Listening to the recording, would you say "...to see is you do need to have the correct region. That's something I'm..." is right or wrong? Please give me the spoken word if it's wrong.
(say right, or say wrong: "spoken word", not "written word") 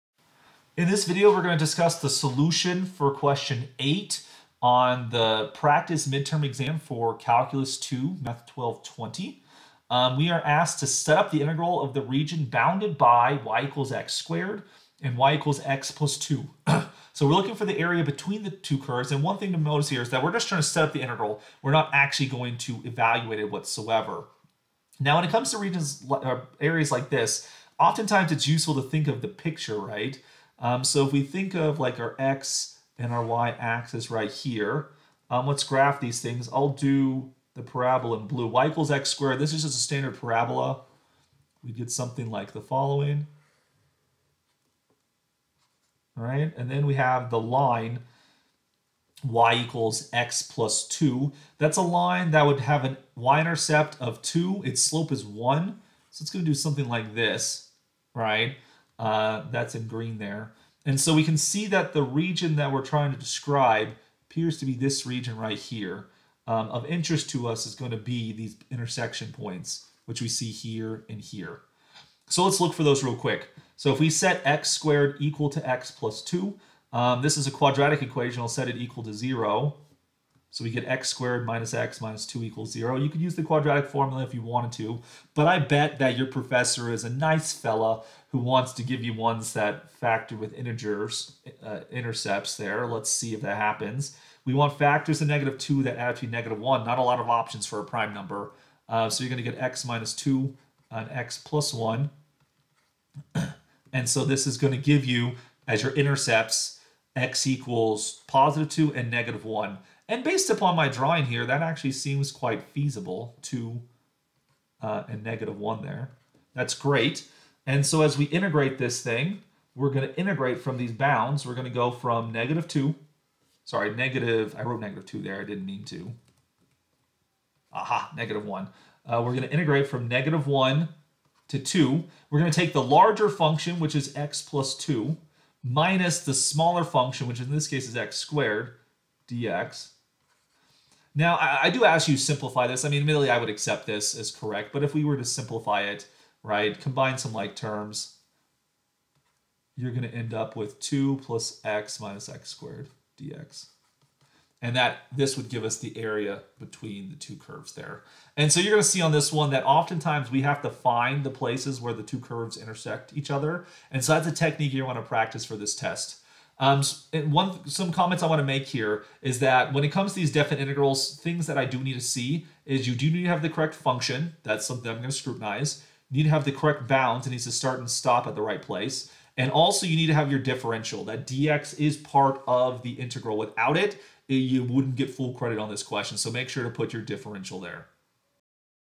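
wrong: "function", not "region".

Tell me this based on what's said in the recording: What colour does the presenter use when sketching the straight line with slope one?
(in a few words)
green.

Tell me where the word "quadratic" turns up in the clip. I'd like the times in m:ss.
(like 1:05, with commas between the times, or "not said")
1:17, 1:23.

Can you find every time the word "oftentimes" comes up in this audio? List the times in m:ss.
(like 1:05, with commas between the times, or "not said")
0:27, 2:39.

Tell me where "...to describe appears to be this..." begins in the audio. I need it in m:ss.
1:03.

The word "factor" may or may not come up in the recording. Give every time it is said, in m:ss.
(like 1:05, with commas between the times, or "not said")
1:29, 1:34.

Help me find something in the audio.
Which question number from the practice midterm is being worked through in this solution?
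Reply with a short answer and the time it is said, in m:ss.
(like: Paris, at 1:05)
8, at 0:03.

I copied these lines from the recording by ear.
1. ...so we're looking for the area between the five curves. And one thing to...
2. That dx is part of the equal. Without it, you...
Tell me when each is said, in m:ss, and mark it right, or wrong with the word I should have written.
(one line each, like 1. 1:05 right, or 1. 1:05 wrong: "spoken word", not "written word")
1. 0:17 wrong: "two", not "five"
2. 3:01 wrong: "integral", not "equal".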